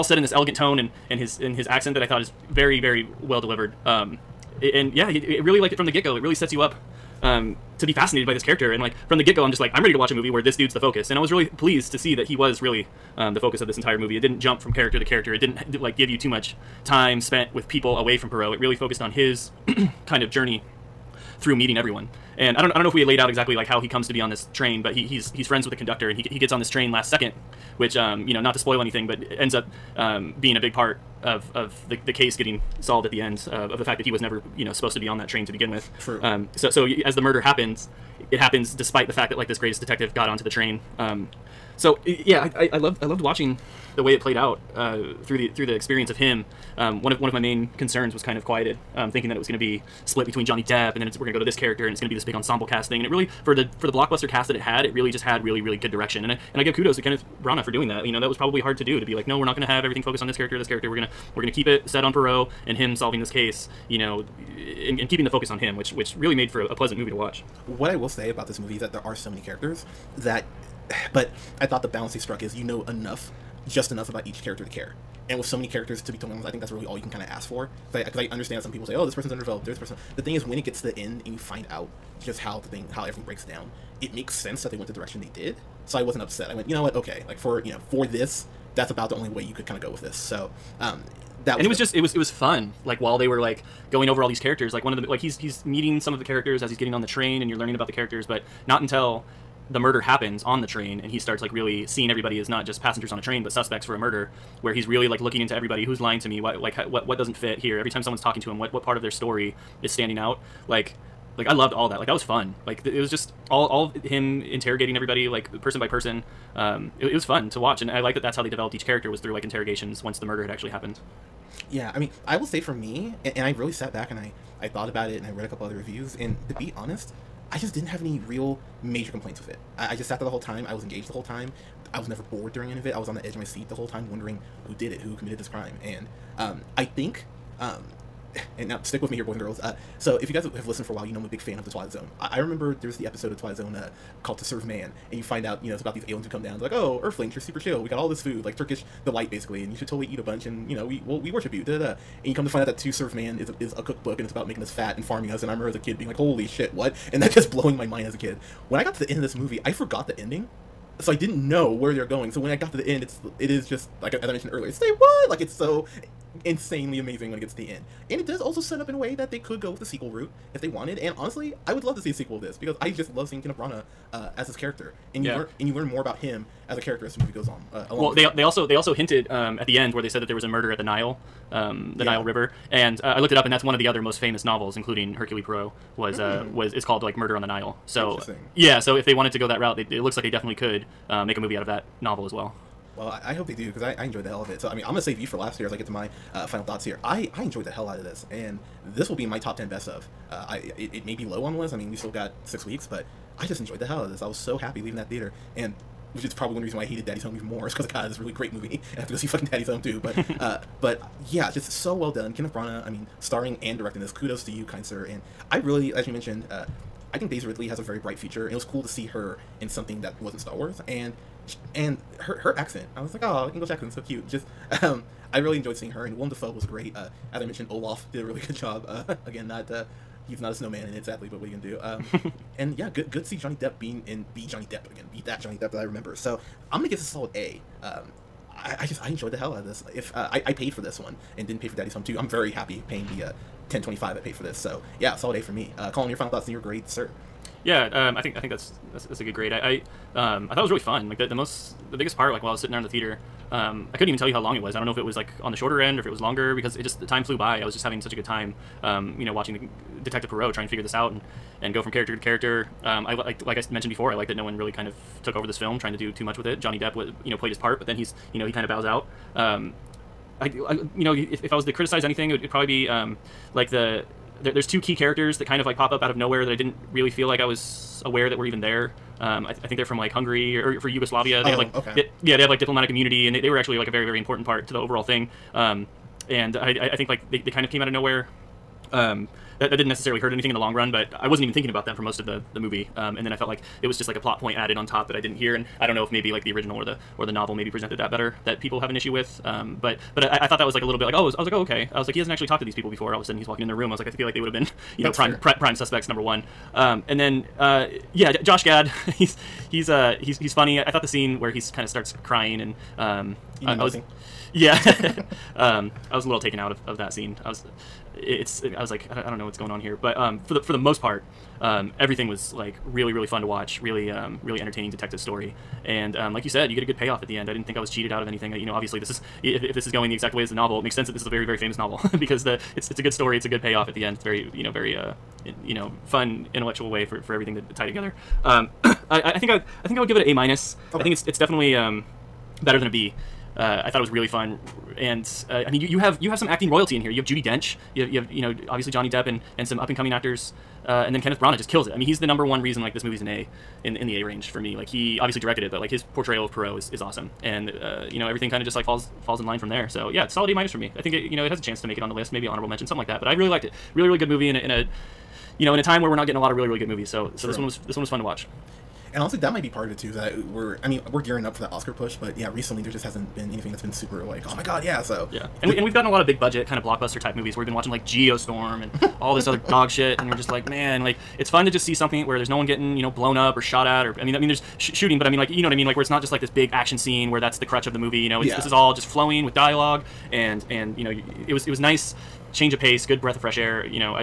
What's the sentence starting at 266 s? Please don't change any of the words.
Johnny Depp, was, you know, played his part, but then he's you know he kind of bows out.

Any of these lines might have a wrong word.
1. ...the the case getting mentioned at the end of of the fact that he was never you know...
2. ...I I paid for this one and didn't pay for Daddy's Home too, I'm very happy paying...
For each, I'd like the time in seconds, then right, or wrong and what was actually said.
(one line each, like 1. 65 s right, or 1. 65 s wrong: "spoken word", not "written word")
1. 31 s wrong: "solved", not "mentioned"
2. 240 s right.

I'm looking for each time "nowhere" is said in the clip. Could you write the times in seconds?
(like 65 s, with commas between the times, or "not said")
276 s, 287 s.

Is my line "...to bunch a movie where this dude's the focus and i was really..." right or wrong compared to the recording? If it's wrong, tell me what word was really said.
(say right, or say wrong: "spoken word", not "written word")
wrong: "watch", not "bunch".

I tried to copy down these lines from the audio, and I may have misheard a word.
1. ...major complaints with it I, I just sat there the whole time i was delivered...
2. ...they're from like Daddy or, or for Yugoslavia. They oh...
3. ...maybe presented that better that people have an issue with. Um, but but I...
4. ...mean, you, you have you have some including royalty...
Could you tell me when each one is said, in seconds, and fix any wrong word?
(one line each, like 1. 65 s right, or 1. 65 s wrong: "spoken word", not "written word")
1. 128 s wrong: "engaged", not "delivered"
2. 279 s wrong: "Hungary", not "Daddy"
3. 297 s right
4. 345 s wrong: "acting", not "including".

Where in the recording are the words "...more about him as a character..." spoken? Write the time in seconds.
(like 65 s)
175 s.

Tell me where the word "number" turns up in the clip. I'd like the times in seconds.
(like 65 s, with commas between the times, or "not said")
306 s, 352 s.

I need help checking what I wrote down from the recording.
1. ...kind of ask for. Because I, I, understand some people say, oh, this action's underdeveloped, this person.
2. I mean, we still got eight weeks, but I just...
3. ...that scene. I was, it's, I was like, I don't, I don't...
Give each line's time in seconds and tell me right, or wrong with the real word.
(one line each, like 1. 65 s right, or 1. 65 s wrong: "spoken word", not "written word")
1. 77 s wrong: "person", not "action"
2. 201 s wrong: "six", not "eight"
3. 316 s right.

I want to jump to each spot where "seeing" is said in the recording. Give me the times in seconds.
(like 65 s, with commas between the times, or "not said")
101 s, 173 s, 225 s.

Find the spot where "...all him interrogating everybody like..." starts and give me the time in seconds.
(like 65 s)
113 s.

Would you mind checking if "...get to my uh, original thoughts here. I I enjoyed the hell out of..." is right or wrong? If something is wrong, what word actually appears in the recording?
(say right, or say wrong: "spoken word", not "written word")
wrong: "final", not "original".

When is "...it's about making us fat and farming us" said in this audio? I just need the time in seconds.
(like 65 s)
154 s.